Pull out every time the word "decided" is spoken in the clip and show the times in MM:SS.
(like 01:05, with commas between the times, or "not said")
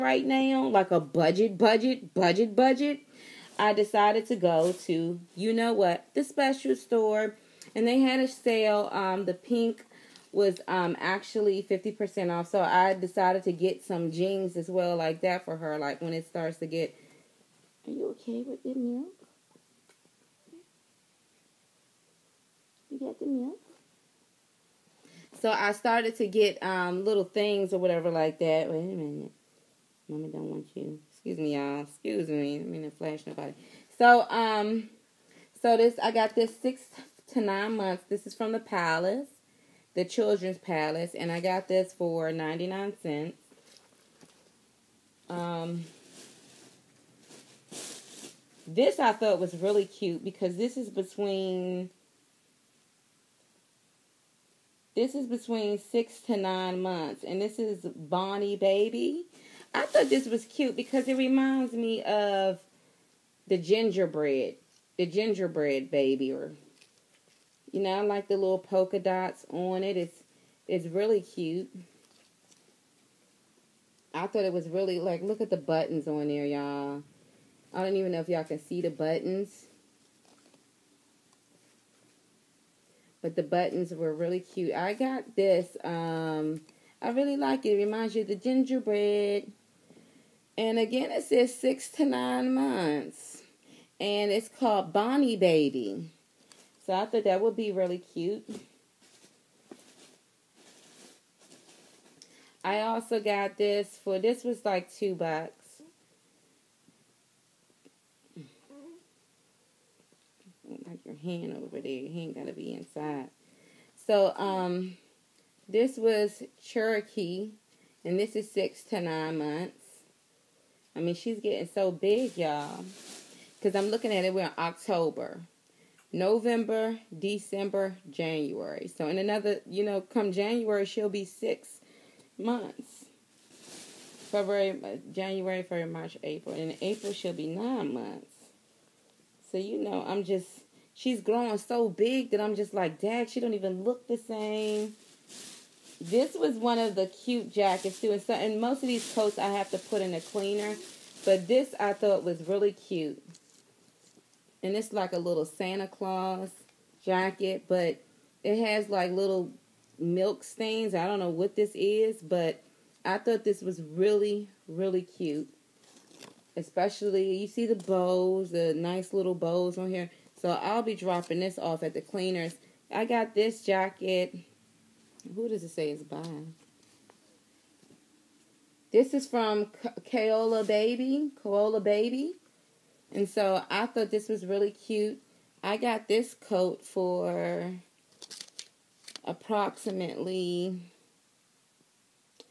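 00:03, 00:12.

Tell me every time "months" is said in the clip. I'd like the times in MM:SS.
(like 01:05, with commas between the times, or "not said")
00:37, 00:56, 01:32, 01:59, 02:12, 02:17.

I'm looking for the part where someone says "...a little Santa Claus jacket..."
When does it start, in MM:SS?
02:35.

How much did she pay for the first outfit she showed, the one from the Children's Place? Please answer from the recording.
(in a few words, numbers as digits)
99 cents.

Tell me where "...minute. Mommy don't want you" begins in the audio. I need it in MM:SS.
00:28.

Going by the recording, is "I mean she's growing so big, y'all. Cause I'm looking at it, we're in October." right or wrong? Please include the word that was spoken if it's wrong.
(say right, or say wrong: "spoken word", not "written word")
wrong: "getting", not "growing".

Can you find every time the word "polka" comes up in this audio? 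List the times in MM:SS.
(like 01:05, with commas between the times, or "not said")
01:08.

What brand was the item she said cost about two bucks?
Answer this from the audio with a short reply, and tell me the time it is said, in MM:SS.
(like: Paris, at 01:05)
Cherokee, at 01:56.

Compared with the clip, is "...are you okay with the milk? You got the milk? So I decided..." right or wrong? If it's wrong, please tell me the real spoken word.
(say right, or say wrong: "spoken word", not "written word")
wrong: "started", not "decided".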